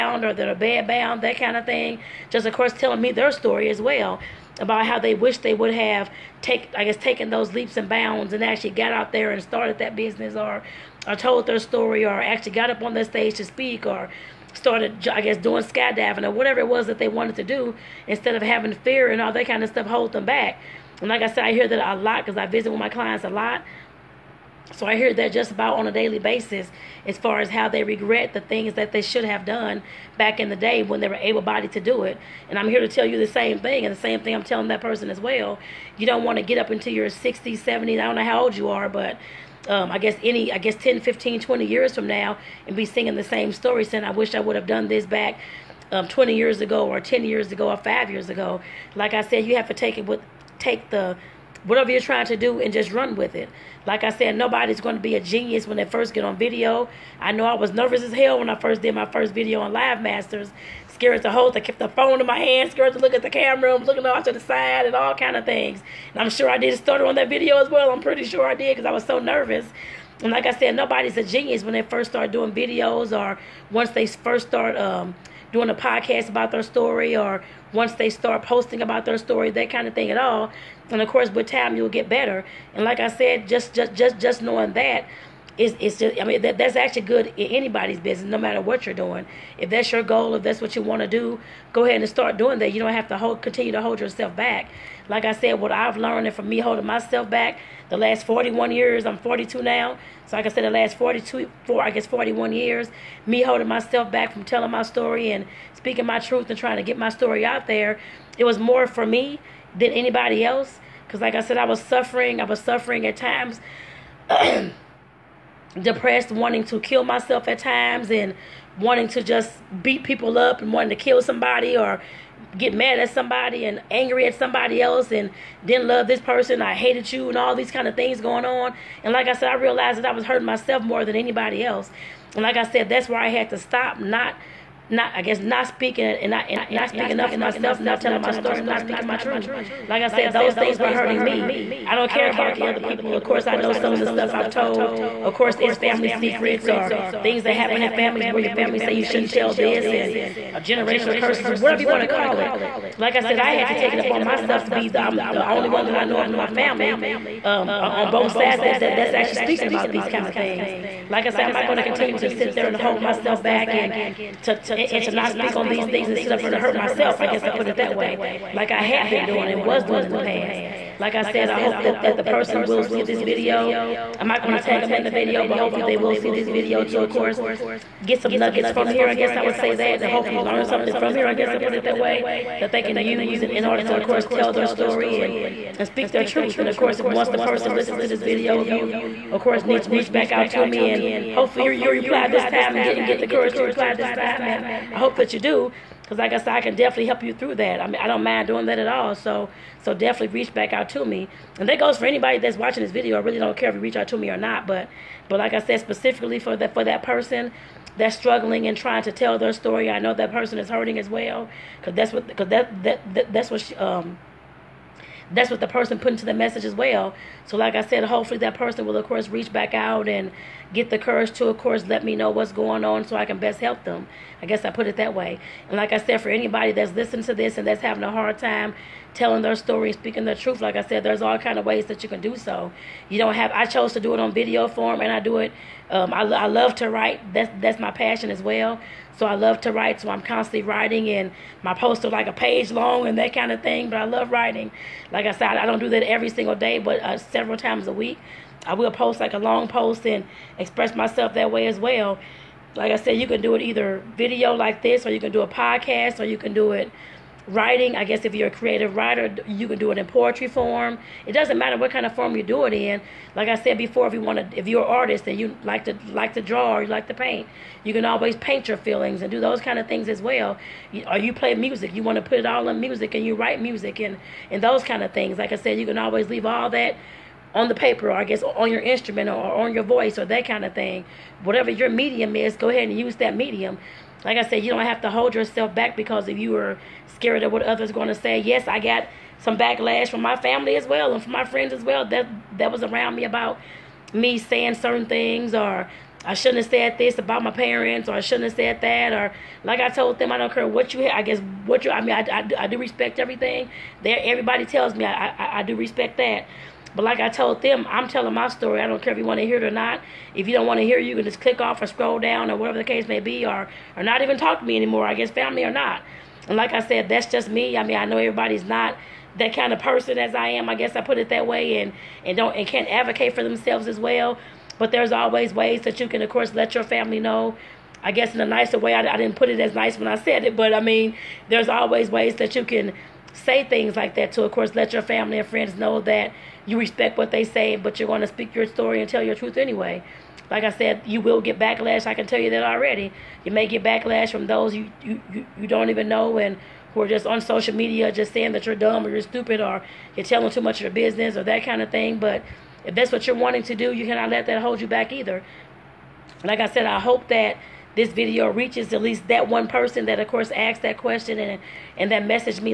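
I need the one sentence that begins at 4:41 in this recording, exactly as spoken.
Whatever your medium is, go ahead and use that medium.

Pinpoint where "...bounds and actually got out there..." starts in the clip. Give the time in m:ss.
0:07.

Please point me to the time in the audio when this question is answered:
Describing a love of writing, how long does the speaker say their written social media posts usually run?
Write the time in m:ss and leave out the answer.
4:02.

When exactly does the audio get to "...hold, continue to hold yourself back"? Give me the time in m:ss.
1:33.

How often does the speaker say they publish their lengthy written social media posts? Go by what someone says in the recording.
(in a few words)
Several times a week.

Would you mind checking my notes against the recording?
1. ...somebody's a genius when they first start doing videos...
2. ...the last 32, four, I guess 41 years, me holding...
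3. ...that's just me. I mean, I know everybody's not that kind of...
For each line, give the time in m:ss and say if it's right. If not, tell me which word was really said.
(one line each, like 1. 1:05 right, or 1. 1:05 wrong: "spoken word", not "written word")
1. 1:10 wrong: "nobody", not "somebody"
2. 1:40 wrong: "42", not "32"
3. 5:17 right.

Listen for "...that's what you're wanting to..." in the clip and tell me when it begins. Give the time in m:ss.
5:52.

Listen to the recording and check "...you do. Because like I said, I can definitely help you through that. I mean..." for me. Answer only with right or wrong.
right.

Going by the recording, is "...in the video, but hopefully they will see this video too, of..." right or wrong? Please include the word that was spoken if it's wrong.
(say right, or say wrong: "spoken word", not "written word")
right.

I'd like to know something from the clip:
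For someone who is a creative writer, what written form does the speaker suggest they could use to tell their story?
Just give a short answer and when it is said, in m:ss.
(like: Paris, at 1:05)
Poetry, at 4:20.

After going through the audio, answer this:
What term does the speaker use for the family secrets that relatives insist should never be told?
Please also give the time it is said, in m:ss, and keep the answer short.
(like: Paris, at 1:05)
Generational curses, at 2:30.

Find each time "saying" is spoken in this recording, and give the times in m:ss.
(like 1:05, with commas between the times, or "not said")
0:43, 4:54, 5:48.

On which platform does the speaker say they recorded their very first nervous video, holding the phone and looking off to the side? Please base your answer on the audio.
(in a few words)
Live Masters.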